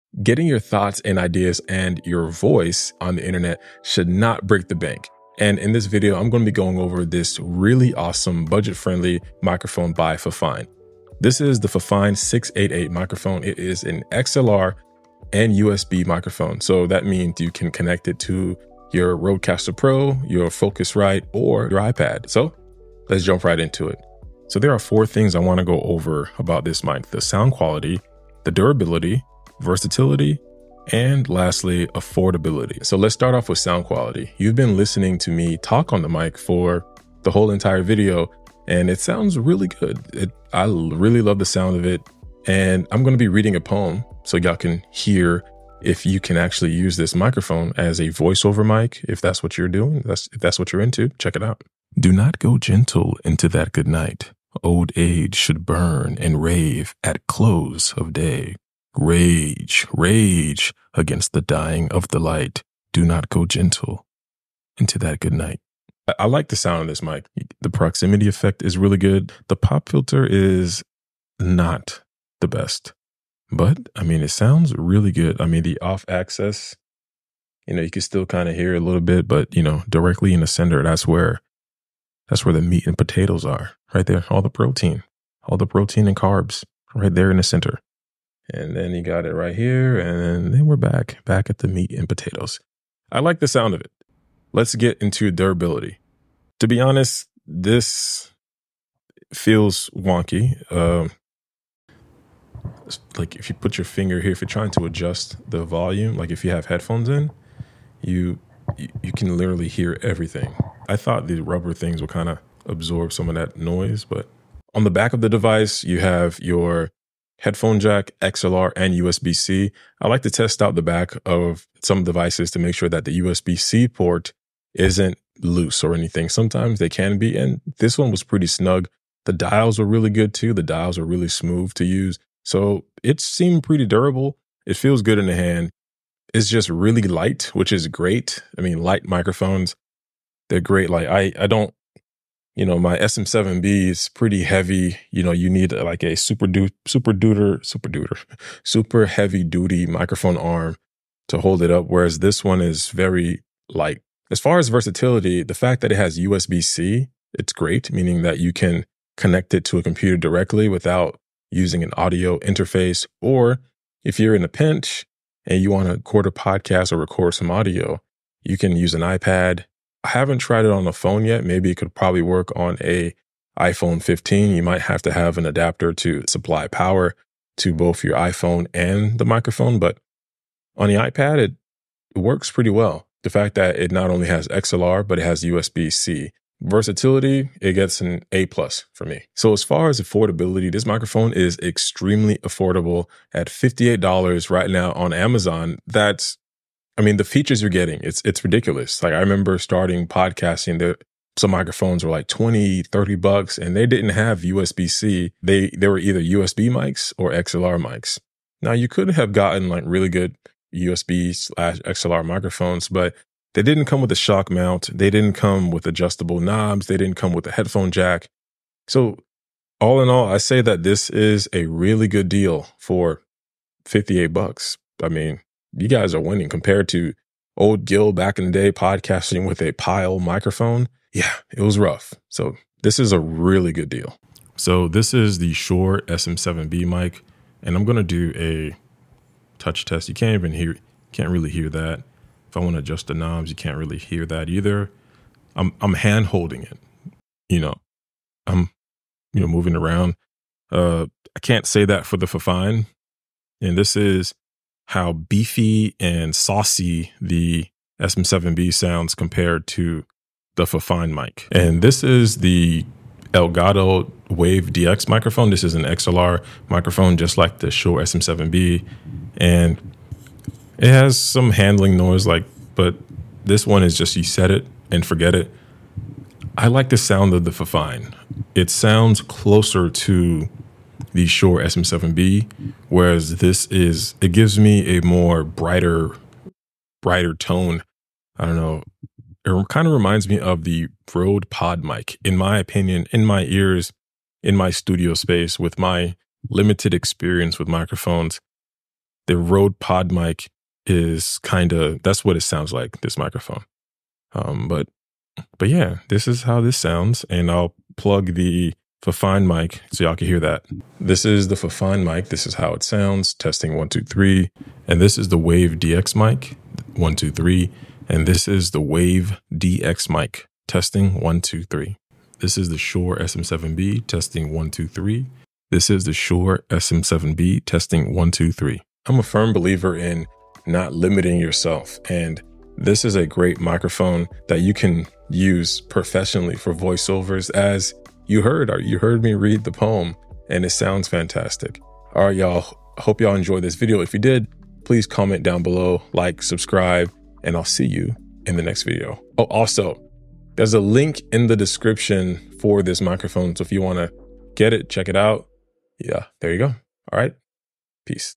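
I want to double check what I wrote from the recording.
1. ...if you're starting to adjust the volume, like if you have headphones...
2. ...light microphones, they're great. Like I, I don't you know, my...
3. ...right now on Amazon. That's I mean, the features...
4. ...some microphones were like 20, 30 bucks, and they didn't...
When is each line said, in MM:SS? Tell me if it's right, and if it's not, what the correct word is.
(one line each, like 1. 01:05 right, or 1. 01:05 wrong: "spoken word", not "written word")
1. 01:44 wrong: "trying", not "starting"
2. 02:18 right
3. 03:14 right
4. 03:21 right.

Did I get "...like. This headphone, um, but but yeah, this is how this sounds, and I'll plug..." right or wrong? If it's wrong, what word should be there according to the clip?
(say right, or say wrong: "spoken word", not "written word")
wrong: "microphone", not "headphone".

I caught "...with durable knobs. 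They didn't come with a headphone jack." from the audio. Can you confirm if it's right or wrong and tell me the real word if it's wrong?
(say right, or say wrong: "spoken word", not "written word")
wrong: "adjustable", not "durable".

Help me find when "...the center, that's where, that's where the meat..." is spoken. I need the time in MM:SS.
01:20.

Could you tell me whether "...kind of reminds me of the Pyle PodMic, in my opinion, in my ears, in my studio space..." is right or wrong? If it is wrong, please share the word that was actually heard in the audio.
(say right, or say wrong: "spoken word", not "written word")
wrong: "Rode", not "Pyle".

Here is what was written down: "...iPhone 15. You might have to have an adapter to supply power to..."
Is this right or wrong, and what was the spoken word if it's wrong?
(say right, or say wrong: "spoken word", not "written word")
right.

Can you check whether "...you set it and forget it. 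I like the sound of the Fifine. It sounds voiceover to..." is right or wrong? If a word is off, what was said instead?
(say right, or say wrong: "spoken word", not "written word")
wrong: "closer", not "voiceover".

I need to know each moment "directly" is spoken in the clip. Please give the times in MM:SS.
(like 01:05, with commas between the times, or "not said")
01:19, 02:40.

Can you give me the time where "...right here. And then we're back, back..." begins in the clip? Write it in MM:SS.
01:29.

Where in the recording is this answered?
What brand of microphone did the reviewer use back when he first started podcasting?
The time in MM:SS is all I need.
03:49.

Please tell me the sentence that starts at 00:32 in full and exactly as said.
So let's start off with sound quality.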